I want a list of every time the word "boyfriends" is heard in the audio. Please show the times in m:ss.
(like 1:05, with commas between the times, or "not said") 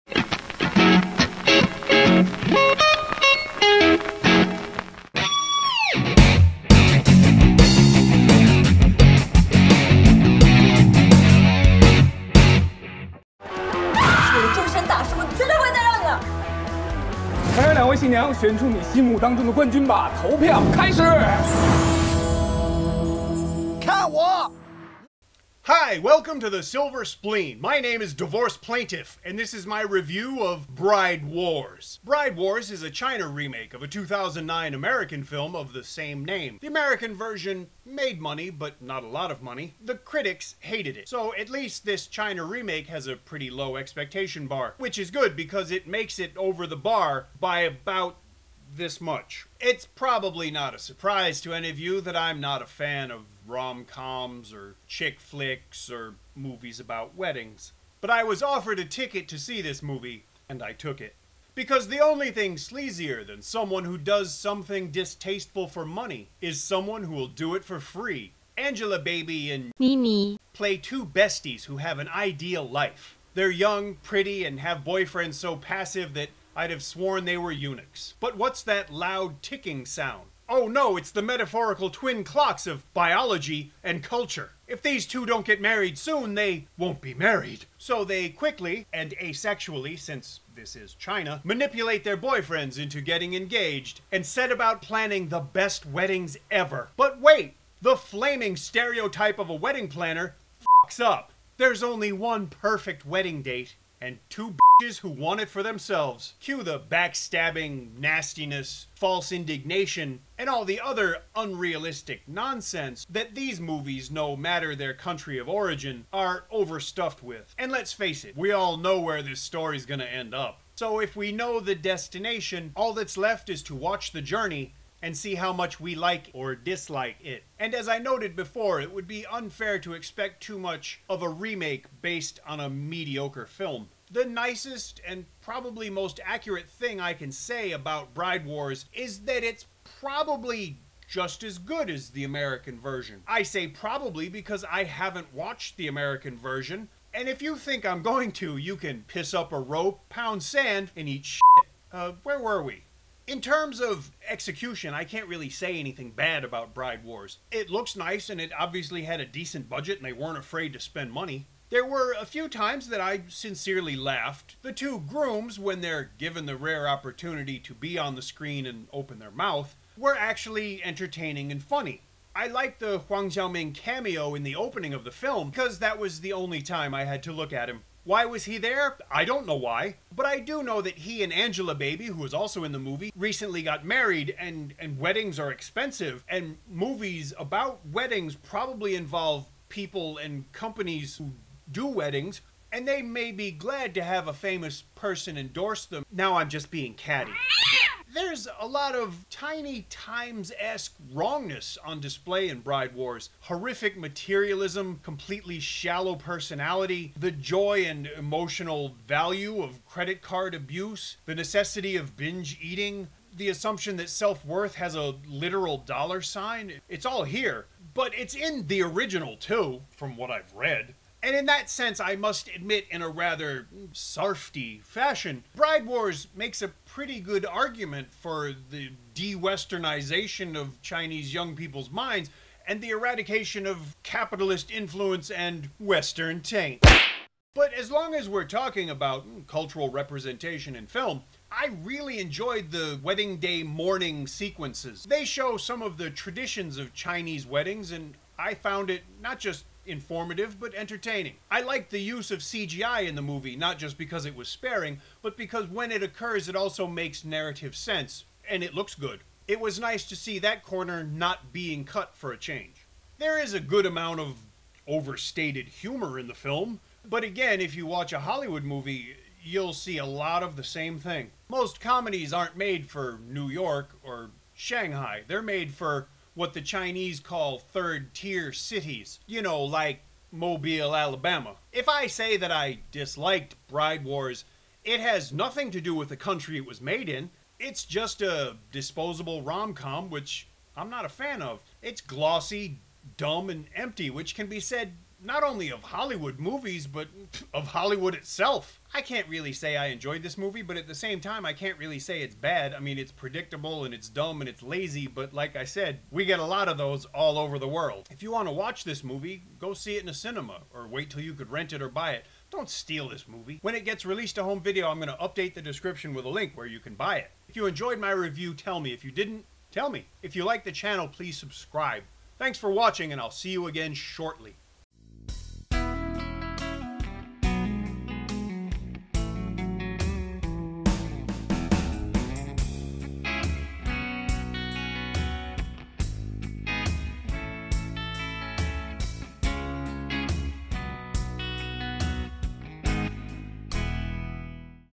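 1:14, 1:32.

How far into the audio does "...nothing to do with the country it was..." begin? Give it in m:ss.
4:45.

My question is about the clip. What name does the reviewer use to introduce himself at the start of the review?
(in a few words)
Divorce Plaintiff.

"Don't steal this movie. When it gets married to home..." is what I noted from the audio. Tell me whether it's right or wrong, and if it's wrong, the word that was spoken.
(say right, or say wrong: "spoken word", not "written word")
wrong: "released", not "married".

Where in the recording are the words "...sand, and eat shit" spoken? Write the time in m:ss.
2:30.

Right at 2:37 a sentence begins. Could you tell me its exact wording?
It looks nice, and it obviously had a decent budget, and they weren't afraid to spend money.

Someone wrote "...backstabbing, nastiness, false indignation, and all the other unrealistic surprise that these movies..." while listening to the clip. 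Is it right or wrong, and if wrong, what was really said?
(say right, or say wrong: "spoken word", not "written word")
wrong: "nonsense", not "surprise".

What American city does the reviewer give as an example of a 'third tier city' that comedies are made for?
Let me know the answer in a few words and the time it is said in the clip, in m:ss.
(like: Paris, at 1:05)
Mobile, Alabama, at 4:40.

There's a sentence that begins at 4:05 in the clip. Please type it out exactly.
They show some of the traditions of Chinese weddings, and I found it not just informative but entertaining.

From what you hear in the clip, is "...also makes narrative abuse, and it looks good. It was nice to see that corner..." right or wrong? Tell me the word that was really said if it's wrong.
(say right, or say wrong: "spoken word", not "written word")
wrong: "sense", not "abuse".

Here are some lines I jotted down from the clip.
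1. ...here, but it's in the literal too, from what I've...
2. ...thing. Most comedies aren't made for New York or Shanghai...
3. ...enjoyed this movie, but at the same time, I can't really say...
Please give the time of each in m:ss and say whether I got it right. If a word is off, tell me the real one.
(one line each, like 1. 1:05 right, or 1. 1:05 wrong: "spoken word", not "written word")
1. 3:37 wrong: "original", not "literal"
2. 4:30 right
3. 4:59 right.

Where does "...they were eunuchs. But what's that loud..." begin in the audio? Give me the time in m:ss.
1:17.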